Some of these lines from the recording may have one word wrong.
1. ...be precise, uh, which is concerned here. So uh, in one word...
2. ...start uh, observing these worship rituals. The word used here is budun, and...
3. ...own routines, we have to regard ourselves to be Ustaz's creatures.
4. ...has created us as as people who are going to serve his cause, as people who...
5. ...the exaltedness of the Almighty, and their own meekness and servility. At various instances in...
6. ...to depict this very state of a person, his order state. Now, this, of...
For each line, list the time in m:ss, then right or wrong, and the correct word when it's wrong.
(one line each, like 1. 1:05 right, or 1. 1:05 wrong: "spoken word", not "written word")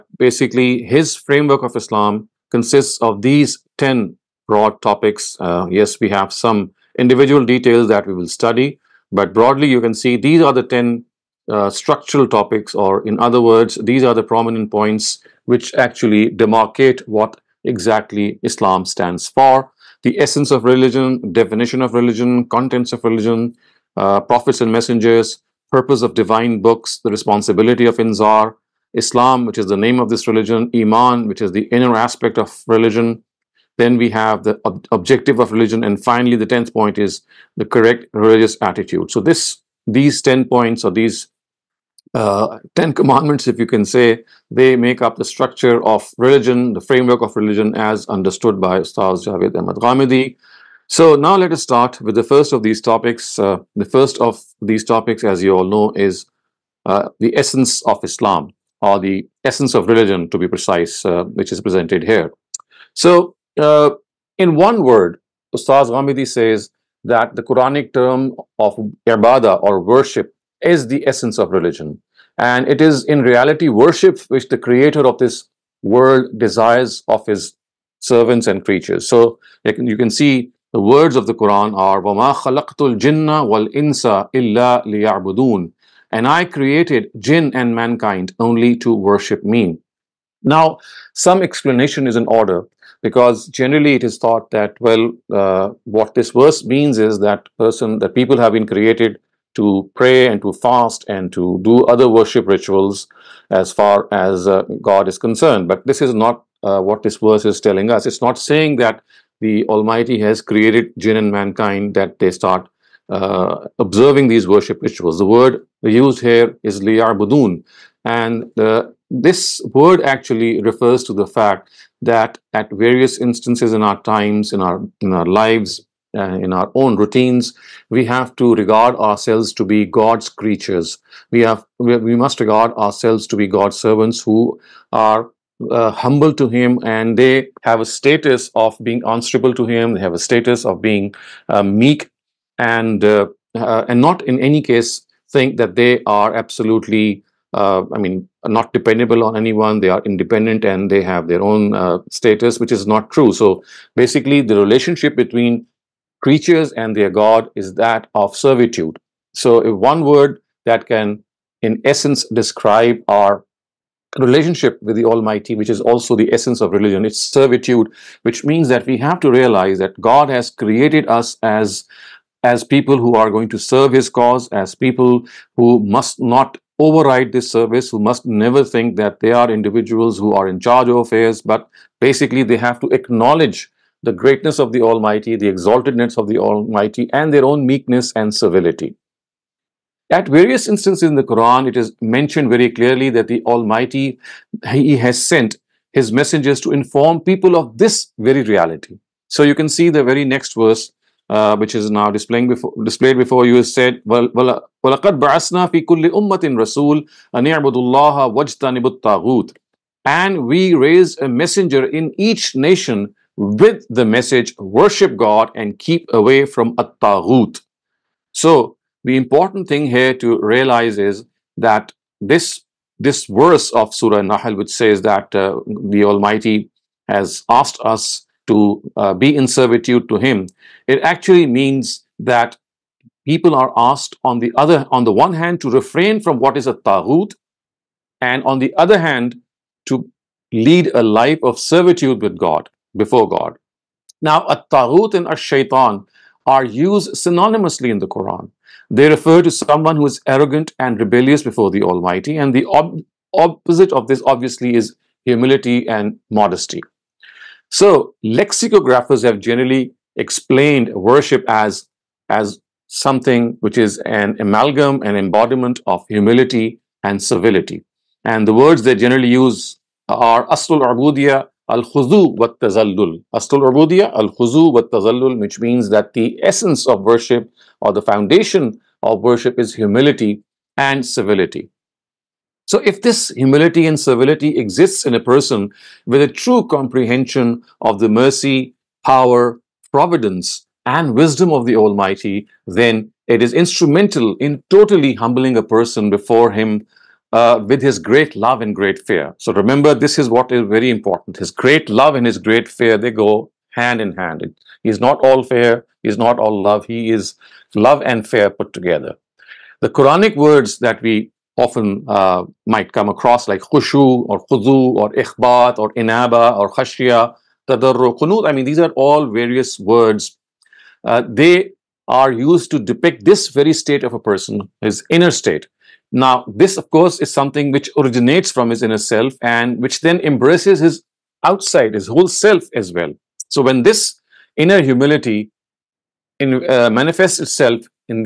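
1. 1:00 wrong: "presented", not "concerned"
2. 1:52 right
3. 2:06 wrong: "God", not "Ustaz"
4. 2:50 right
5. 3:05 right
6. 5:22 wrong: "inner", not "order".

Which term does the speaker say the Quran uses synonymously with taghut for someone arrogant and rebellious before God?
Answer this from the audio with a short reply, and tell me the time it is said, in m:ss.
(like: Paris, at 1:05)
shaitan, at 4:05.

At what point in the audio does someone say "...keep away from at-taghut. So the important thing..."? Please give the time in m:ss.
3:35.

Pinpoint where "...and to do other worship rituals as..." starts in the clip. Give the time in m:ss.
1:41.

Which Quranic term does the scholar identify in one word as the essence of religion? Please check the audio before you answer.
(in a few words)
ibadah.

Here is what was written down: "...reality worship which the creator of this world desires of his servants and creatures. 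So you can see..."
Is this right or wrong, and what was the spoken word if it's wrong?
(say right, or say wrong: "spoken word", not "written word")
right.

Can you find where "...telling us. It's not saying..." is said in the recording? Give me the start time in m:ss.
1:47.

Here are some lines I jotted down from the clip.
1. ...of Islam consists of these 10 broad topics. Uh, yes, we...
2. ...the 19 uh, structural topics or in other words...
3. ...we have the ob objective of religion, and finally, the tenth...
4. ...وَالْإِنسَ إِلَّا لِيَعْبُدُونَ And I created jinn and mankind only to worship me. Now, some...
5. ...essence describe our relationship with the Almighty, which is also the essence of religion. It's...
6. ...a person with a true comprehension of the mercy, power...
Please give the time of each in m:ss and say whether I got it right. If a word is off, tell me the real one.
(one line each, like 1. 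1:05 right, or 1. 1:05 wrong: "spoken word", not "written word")
1. 0:01 right
2. 0:10 wrong: "10", not "19"
3. 0:33 right
4. 1:23 right
5. 2:41 right
6. 4:45 right.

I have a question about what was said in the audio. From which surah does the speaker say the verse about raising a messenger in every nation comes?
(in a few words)
Surah Nahl.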